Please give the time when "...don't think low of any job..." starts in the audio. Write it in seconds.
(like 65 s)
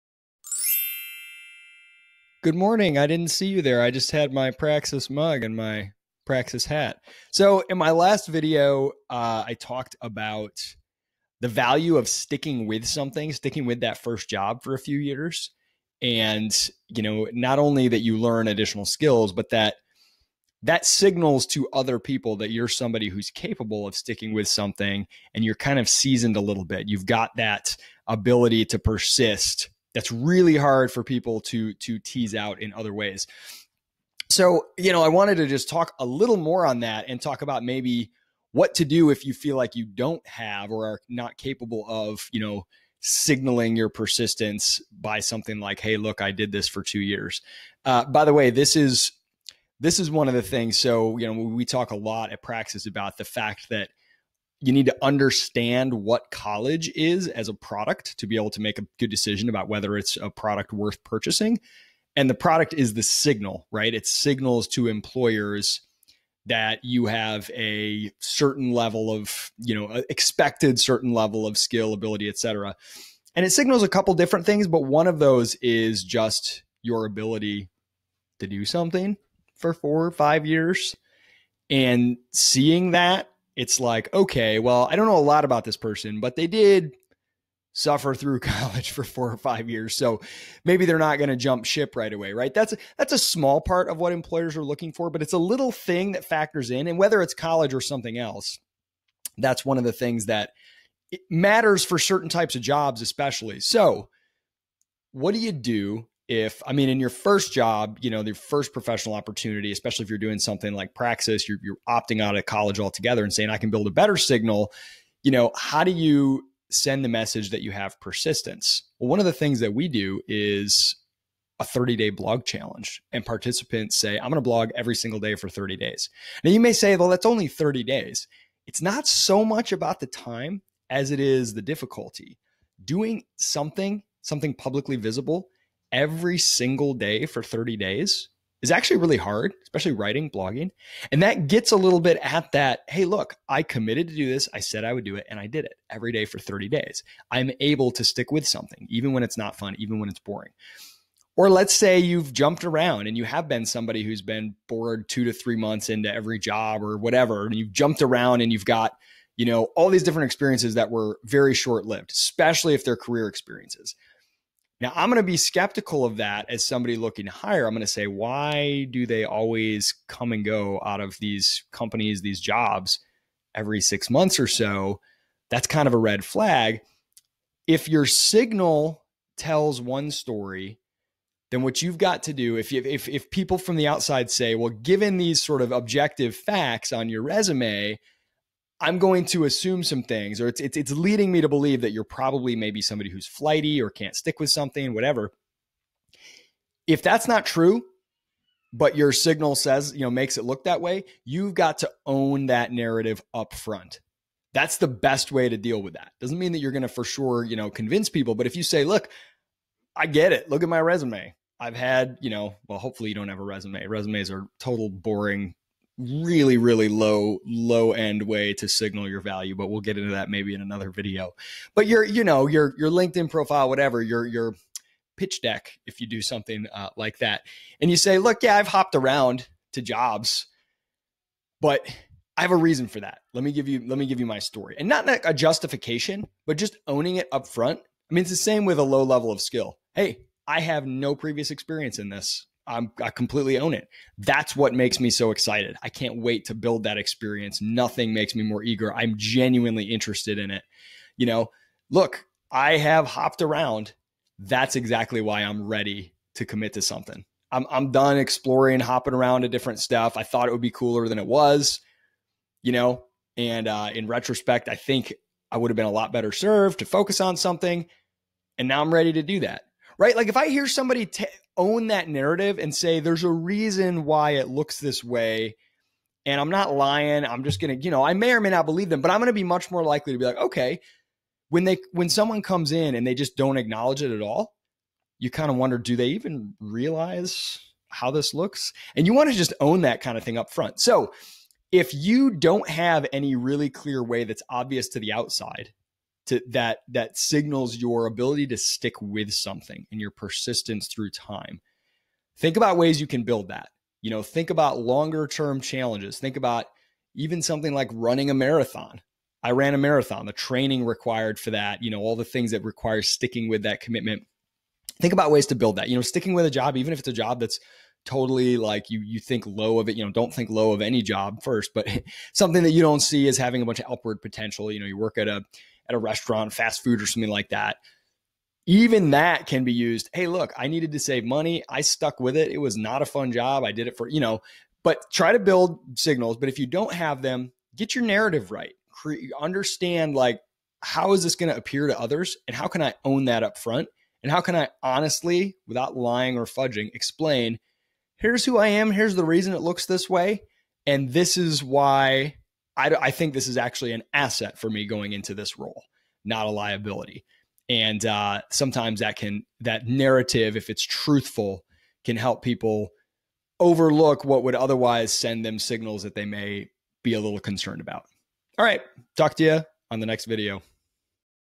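320 s.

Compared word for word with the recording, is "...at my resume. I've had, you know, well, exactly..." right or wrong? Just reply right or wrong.
wrong.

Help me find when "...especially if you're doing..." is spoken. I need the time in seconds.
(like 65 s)
109 s.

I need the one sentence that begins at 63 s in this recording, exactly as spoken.
It signals to employers that you have a certain level of, you know, expected certain level of skill, ability, et cetera.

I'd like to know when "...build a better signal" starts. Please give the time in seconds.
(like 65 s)
113 s.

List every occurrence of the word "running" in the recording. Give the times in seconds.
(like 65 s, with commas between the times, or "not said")
307 s.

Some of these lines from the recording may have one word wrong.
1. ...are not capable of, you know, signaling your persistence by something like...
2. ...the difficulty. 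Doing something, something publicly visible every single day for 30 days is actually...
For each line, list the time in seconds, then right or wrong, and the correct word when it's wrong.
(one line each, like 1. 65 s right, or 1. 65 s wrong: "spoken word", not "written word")
1. 40 s right
2. 131 s right.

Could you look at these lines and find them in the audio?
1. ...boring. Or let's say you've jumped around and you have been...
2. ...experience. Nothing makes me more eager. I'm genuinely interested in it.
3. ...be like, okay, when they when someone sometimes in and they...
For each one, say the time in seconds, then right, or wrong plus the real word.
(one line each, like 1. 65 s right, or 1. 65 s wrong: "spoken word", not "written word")
1. 150 s right
2. 246 s right
3. 280 s wrong: "comes", not "sometimes".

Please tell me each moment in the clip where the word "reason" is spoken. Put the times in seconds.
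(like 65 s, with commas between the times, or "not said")
232 s, 273 s, 349 s.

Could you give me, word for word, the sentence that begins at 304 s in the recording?
You know, think about longer term challenges.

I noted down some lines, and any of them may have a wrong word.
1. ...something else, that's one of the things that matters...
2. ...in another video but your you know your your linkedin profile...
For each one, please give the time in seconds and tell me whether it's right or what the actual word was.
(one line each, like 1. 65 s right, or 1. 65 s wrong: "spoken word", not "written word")
1. 97 s right
2. 220 s right.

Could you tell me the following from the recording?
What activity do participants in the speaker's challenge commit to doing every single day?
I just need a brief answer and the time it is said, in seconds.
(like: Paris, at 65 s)
Blogging, at 124 s.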